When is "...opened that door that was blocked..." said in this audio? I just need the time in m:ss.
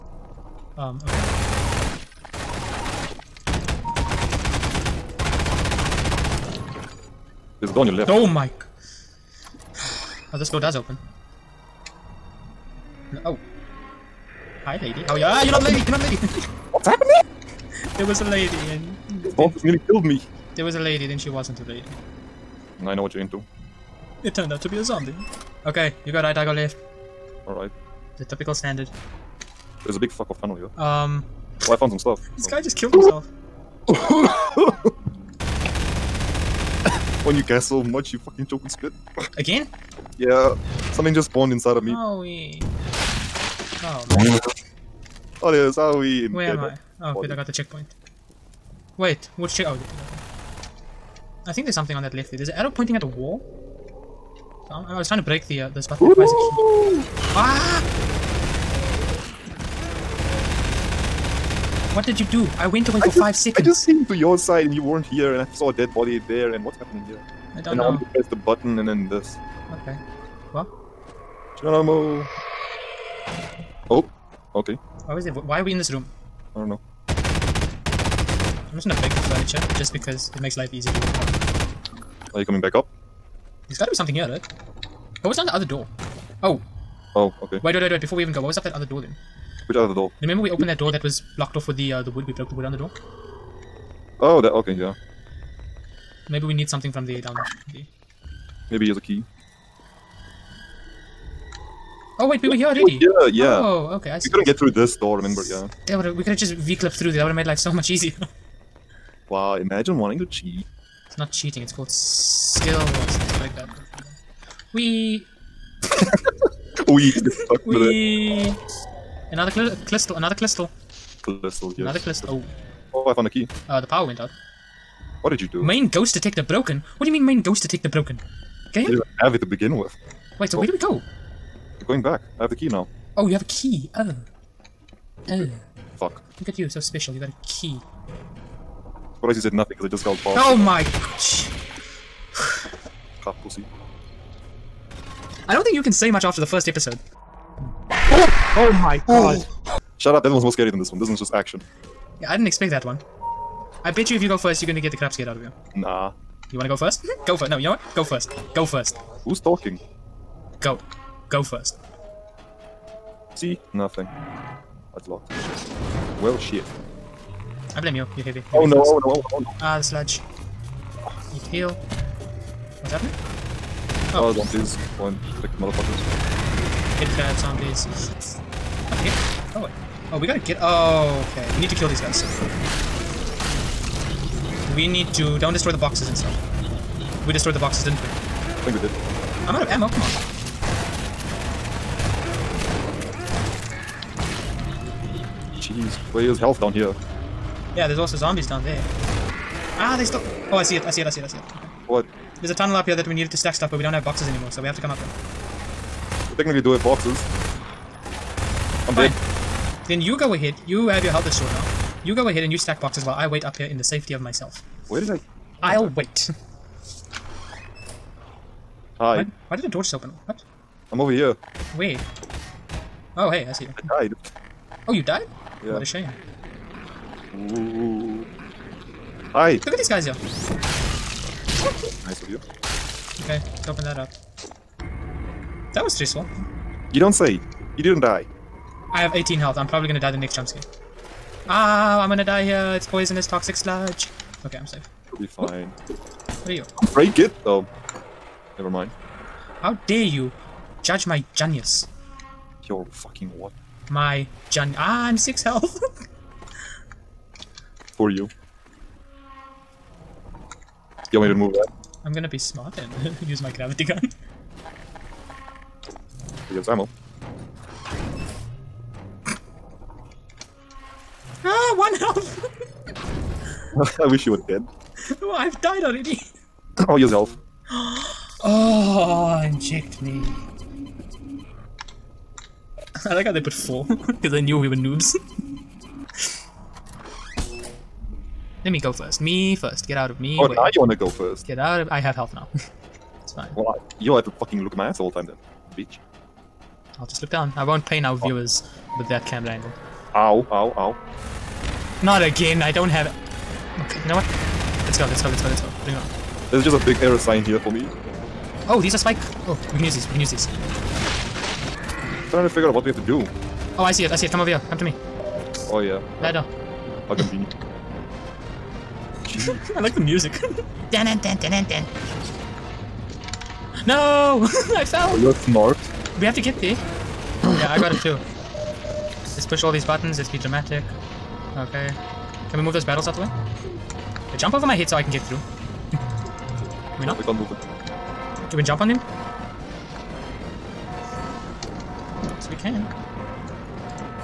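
1:30.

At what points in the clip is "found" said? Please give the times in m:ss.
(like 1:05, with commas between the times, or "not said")
0:31, 2:03.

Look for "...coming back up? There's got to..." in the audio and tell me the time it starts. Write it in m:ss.
1:22.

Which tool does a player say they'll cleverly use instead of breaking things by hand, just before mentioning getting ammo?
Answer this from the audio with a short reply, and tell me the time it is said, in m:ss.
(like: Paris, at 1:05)
Gravity gun, at 4:23.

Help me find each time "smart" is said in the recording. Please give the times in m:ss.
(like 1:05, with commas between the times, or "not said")
4:22, 5:25.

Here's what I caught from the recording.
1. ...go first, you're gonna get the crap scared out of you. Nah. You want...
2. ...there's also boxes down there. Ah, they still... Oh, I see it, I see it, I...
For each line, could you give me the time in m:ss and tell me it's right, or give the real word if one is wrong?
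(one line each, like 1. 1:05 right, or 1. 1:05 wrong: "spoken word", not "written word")
1. 2:34 right
2. 3:17 wrong: "zombies", not "boxes".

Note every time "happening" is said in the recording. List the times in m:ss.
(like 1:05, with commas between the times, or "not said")
0:16, 1:06, 2:52.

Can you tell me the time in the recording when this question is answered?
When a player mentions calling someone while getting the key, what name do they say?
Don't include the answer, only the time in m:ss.
2:20.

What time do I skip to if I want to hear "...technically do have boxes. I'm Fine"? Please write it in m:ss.
3:26.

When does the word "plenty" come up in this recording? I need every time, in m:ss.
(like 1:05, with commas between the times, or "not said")
not said.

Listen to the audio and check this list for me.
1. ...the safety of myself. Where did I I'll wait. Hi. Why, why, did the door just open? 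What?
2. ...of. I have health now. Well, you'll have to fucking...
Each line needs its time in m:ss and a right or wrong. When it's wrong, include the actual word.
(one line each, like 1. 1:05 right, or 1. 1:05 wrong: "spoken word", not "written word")
1. 3:33 right
2. 4:51 right.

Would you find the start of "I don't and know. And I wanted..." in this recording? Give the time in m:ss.
1:07.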